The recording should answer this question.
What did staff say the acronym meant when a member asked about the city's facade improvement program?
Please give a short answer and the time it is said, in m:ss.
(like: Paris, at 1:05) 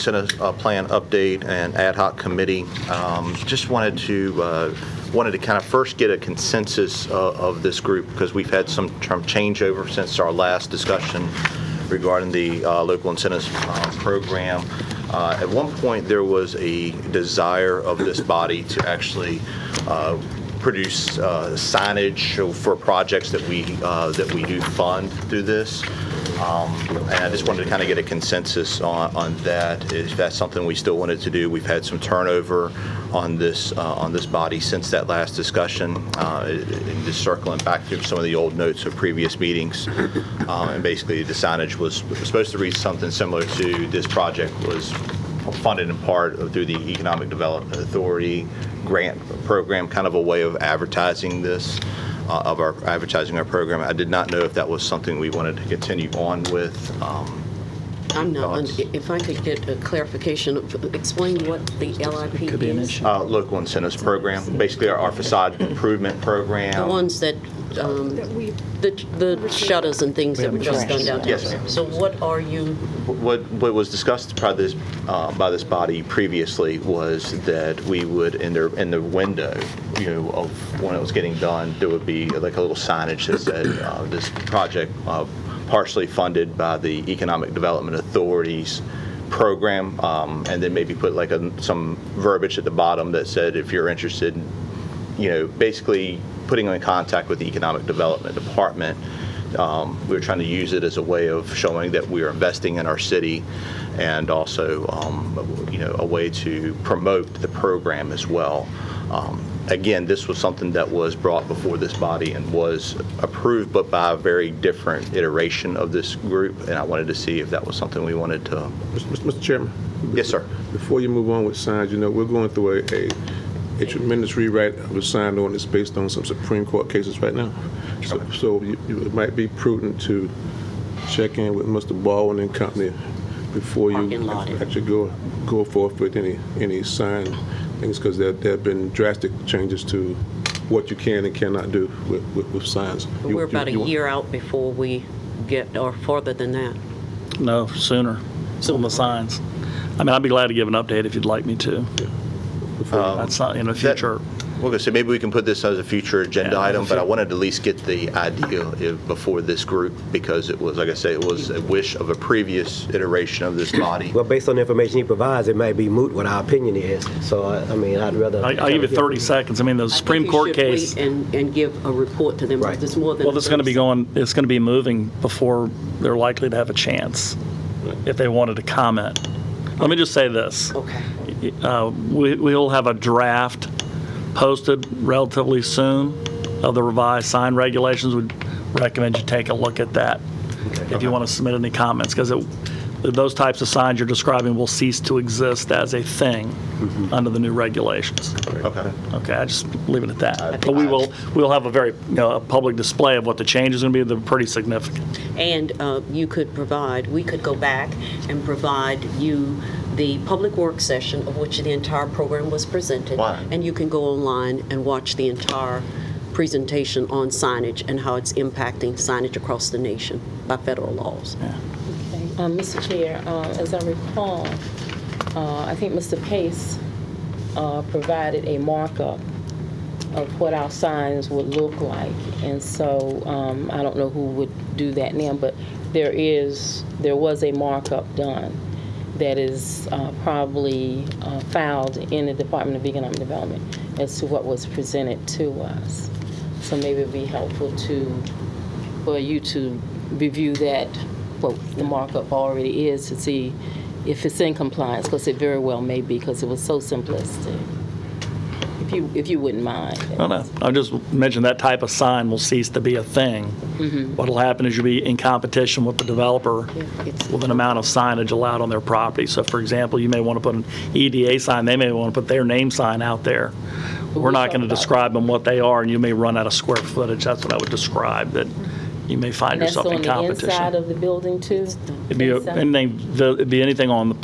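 Local incentives program, at 1:03.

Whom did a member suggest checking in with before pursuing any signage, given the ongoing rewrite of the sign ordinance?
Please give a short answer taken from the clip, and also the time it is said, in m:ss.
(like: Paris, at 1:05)
Mr. Baldwin, at 2:11.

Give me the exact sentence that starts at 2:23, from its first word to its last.
You, we're about you, a year out before we get or further than that.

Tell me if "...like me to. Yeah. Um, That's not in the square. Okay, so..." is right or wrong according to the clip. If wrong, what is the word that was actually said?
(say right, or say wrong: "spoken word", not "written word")
wrong: "future", not "square".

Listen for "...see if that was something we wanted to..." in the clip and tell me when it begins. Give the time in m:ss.
1:57.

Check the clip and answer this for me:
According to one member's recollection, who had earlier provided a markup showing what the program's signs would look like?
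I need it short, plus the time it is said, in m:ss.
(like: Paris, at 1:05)
Mr. Pace, at 3:45.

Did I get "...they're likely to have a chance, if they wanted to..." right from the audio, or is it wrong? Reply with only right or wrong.
right.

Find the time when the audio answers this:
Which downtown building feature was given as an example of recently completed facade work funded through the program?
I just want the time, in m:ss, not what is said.
1:09.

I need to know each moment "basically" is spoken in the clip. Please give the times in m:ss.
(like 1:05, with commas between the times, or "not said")
0:40, 1:04, 1:35.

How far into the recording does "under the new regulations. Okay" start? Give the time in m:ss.
3:17.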